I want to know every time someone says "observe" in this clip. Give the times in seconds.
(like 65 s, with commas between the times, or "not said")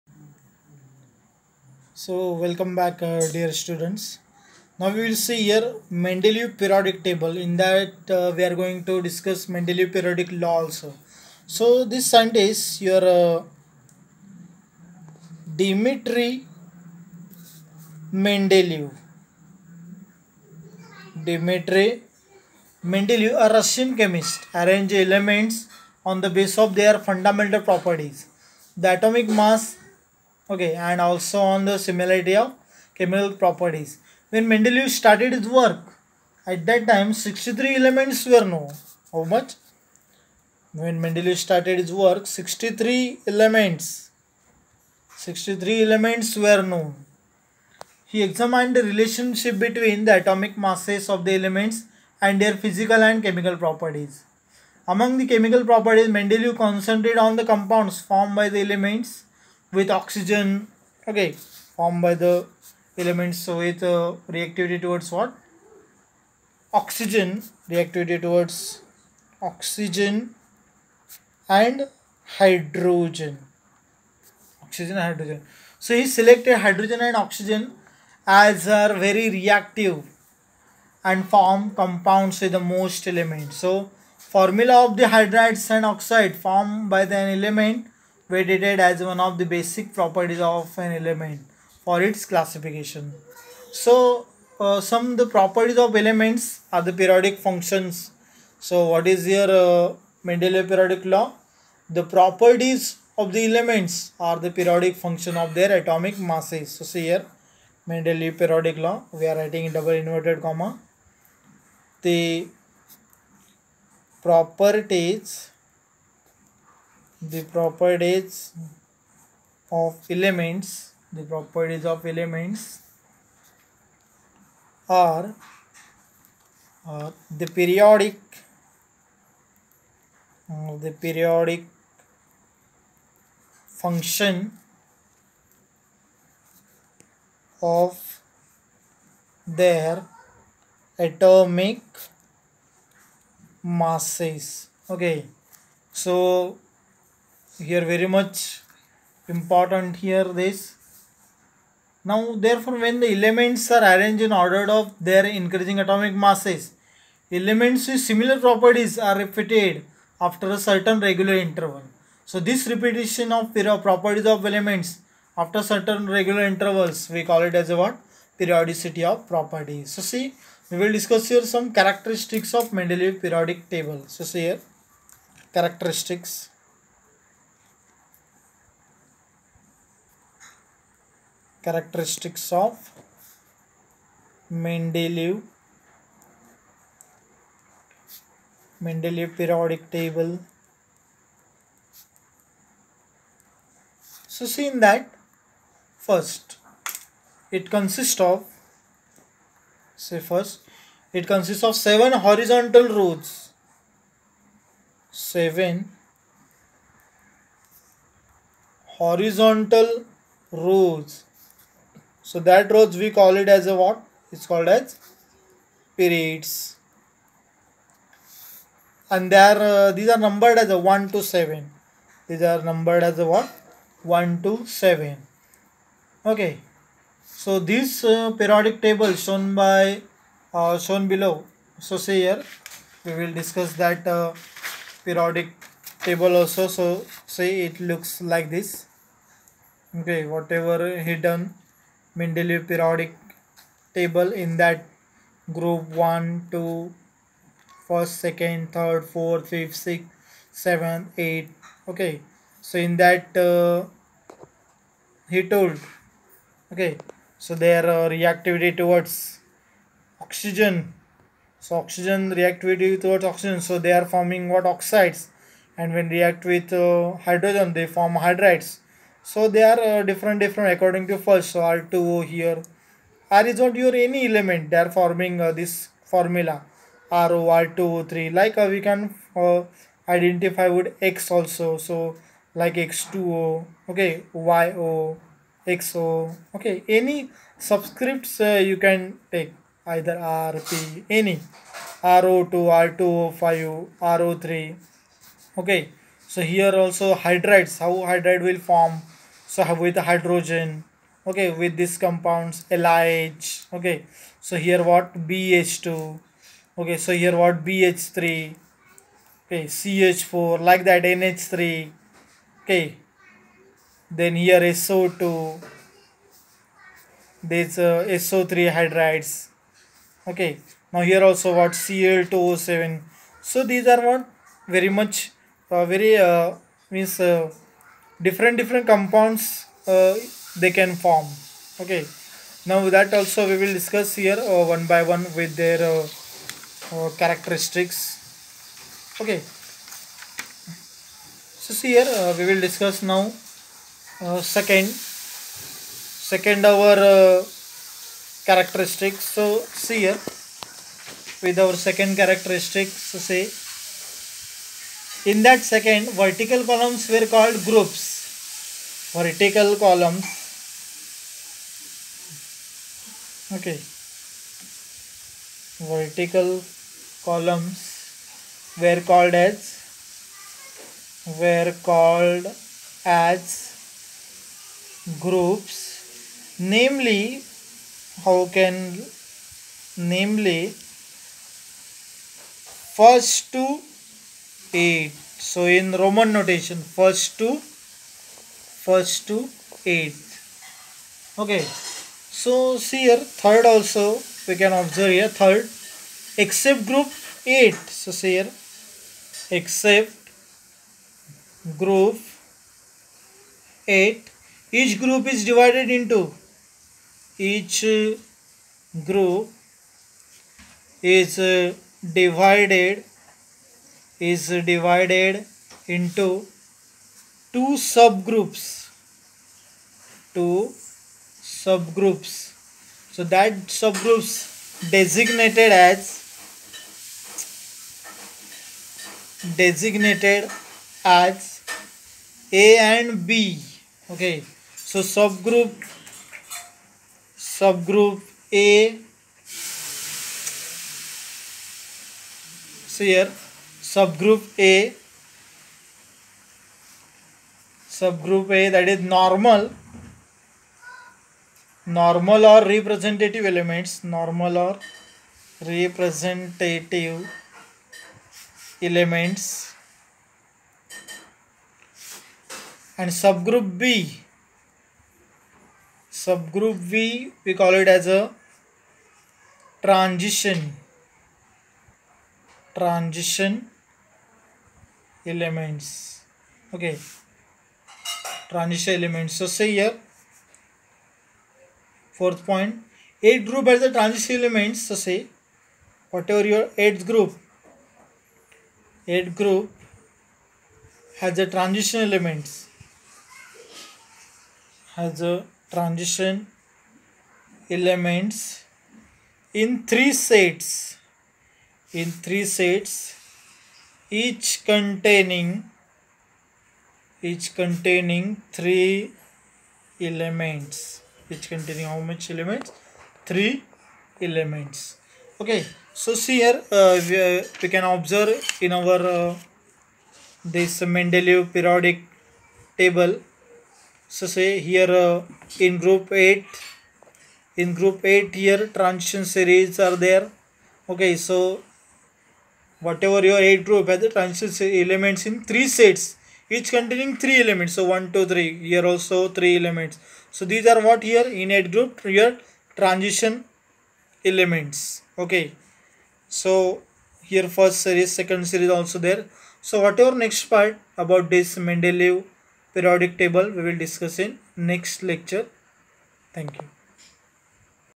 394 s, 517 s.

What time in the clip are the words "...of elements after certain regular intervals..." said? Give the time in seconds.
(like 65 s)
164 s.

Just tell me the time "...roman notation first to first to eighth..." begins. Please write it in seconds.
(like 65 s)
386 s.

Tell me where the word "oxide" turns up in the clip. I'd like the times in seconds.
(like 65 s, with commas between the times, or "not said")
85 s, 264 s.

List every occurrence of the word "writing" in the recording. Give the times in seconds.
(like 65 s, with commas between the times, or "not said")
109 s.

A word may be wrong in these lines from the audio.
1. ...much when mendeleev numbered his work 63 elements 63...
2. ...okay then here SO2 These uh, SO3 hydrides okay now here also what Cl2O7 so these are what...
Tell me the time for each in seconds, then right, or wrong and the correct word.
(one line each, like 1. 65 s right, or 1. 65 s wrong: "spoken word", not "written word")
1. 39 s wrong: "started", not "numbered"
2. 312 s right.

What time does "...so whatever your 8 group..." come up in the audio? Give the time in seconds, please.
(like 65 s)
531 s.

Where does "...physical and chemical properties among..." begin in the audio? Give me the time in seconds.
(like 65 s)
52 s.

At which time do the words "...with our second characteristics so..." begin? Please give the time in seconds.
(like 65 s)
351 s.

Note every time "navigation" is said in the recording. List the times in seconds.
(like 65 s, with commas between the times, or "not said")
not said.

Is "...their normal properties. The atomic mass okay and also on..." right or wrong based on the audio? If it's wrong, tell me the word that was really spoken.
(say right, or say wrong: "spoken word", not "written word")
wrong: "fundamental", not "normal".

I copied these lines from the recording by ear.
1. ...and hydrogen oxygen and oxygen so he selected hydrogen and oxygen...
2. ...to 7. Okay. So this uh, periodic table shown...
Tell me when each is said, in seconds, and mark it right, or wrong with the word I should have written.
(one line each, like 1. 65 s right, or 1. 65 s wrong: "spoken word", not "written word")
1. 71 s wrong: "hydrogen", not "oxygen"
2. 224 s right.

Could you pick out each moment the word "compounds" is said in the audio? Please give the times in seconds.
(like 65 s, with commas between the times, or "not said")
57 s, 81 s, 302 s, 328 s.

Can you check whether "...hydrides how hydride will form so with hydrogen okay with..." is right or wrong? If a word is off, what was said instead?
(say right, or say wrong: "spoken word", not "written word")
right.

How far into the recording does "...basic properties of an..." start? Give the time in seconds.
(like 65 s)
89 s.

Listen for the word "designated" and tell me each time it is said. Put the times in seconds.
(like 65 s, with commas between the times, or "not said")
424 s, 429 s.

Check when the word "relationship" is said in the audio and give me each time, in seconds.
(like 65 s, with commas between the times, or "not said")
48 s.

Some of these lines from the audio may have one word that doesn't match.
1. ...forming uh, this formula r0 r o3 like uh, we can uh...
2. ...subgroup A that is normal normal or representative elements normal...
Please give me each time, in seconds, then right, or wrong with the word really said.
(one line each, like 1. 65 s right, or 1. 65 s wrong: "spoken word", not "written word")
1. 274 s right
2. 447 s right.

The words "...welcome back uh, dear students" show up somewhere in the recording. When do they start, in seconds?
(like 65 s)
2 s.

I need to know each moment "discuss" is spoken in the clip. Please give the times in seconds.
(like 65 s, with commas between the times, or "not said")
9 s, 170 s, 233 s, 333 s, 342 s, 553 s.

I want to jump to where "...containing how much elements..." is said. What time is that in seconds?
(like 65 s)
511 s.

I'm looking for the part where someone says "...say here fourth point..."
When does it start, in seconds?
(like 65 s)
479 s.